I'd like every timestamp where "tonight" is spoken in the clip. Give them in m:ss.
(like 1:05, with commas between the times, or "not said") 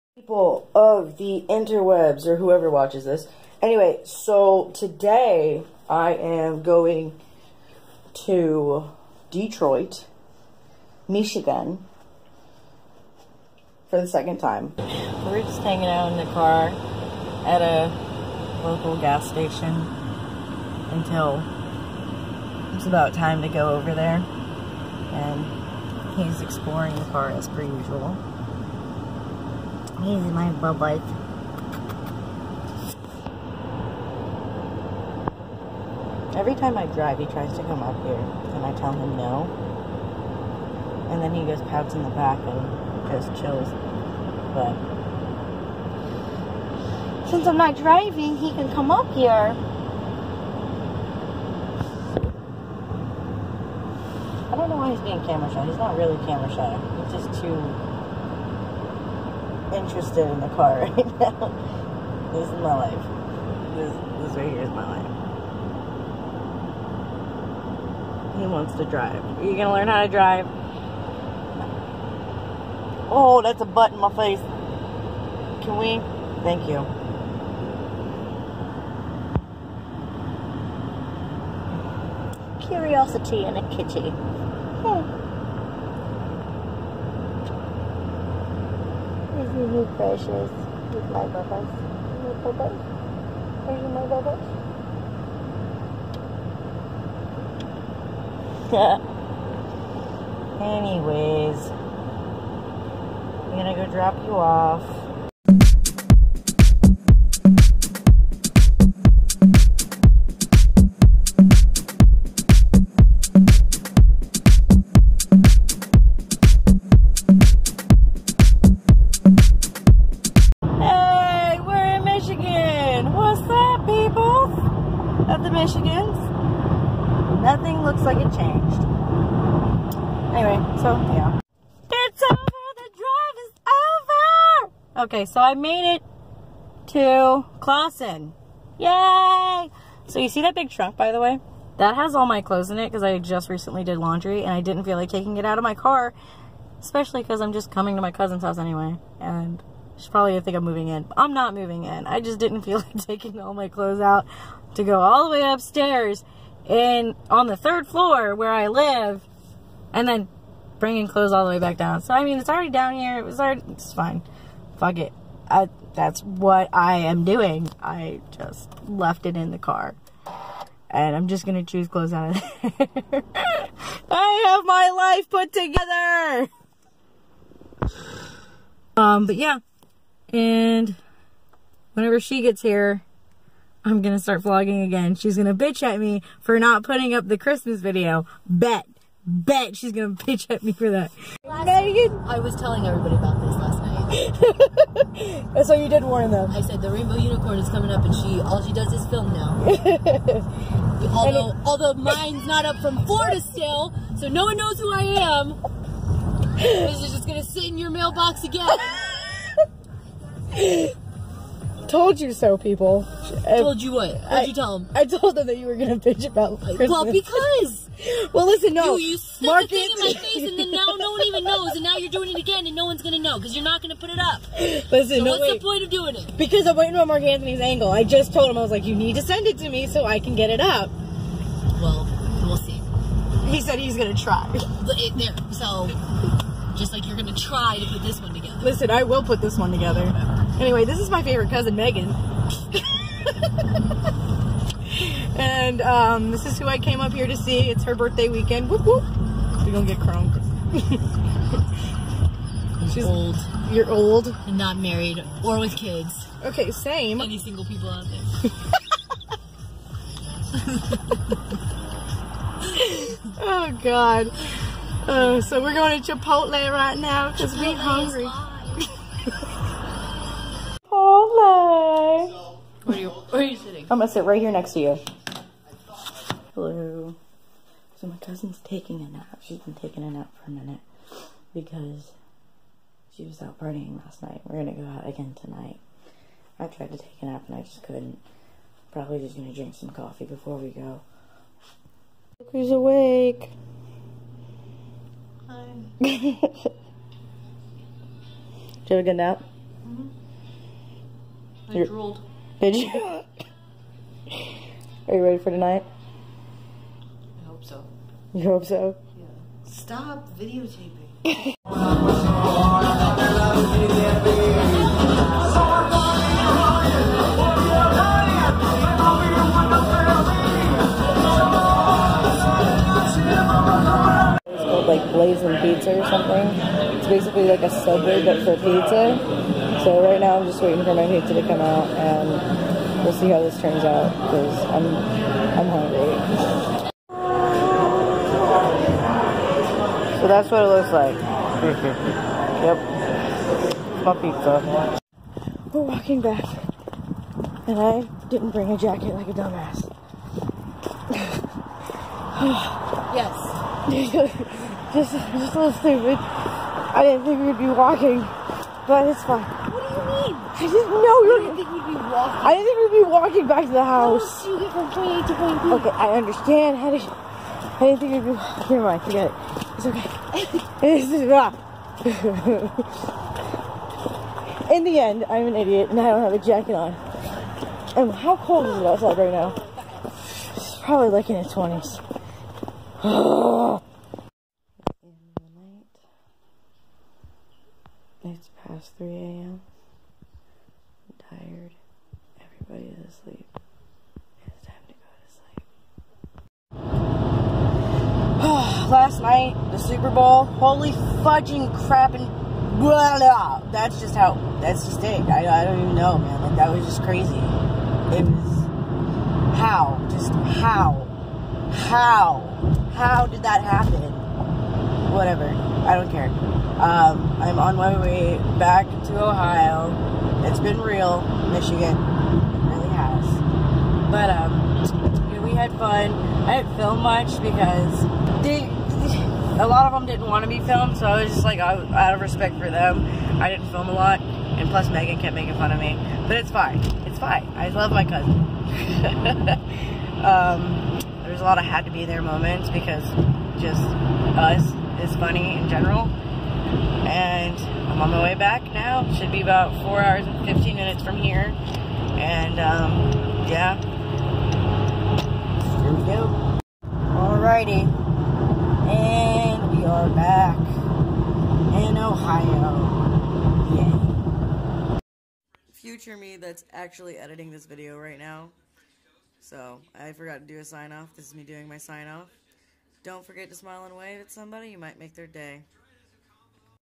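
4:45, 5:05.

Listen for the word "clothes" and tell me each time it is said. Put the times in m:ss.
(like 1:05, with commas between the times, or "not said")
2:22, 2:33, 2:41, 2:51.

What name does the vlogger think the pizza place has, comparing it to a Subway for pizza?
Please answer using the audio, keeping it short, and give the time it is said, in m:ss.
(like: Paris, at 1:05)
Blazing Pizza, at 5:25.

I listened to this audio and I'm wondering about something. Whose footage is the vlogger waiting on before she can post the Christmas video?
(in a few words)
Mark Anthony.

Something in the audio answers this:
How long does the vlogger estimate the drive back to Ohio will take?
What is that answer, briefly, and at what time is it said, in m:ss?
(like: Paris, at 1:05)
4 hours and 15 minutes, at 7:29.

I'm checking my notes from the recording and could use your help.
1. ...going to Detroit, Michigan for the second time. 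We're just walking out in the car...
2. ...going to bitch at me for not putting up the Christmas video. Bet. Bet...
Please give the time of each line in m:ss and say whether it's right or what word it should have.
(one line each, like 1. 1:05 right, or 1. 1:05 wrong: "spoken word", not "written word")
1. 0:06 wrong: "hanging", not "walking"
2. 3:05 right.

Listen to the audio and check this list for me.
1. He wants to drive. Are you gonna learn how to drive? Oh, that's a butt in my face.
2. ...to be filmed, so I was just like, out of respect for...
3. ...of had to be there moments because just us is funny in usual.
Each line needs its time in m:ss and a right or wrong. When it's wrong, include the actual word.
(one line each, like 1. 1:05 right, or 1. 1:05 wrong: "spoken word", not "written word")
1. 1:08 right
2. 7:10 right
3. 7:21 wrong: "general", not "usual".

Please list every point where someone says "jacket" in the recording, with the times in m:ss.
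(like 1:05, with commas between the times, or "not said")
5:48, 6:16.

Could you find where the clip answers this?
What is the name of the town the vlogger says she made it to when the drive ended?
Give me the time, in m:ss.
2:17.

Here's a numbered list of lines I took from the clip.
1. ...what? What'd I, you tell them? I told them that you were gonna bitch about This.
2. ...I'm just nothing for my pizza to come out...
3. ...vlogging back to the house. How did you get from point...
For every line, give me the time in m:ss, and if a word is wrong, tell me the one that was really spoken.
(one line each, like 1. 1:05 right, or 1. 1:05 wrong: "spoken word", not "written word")
1. 3:33 wrong: "Christmas", not "This"
2. 5:30 wrong: "waiting", not "nothing"
3. 6:03 wrong: "walking", not "vlogging".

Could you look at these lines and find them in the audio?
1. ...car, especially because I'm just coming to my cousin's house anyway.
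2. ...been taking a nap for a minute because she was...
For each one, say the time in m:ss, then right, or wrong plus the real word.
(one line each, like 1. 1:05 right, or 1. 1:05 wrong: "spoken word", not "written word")
1. 2:25 right
2. 4:39 right.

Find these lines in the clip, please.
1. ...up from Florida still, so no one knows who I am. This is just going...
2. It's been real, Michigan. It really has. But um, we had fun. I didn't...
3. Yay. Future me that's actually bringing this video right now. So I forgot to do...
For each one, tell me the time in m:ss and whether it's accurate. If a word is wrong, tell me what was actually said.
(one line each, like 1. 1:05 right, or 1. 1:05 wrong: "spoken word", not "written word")
1. 3:22 right
2. 7:00 right
3. 7:43 wrong: "editing", not "bringing".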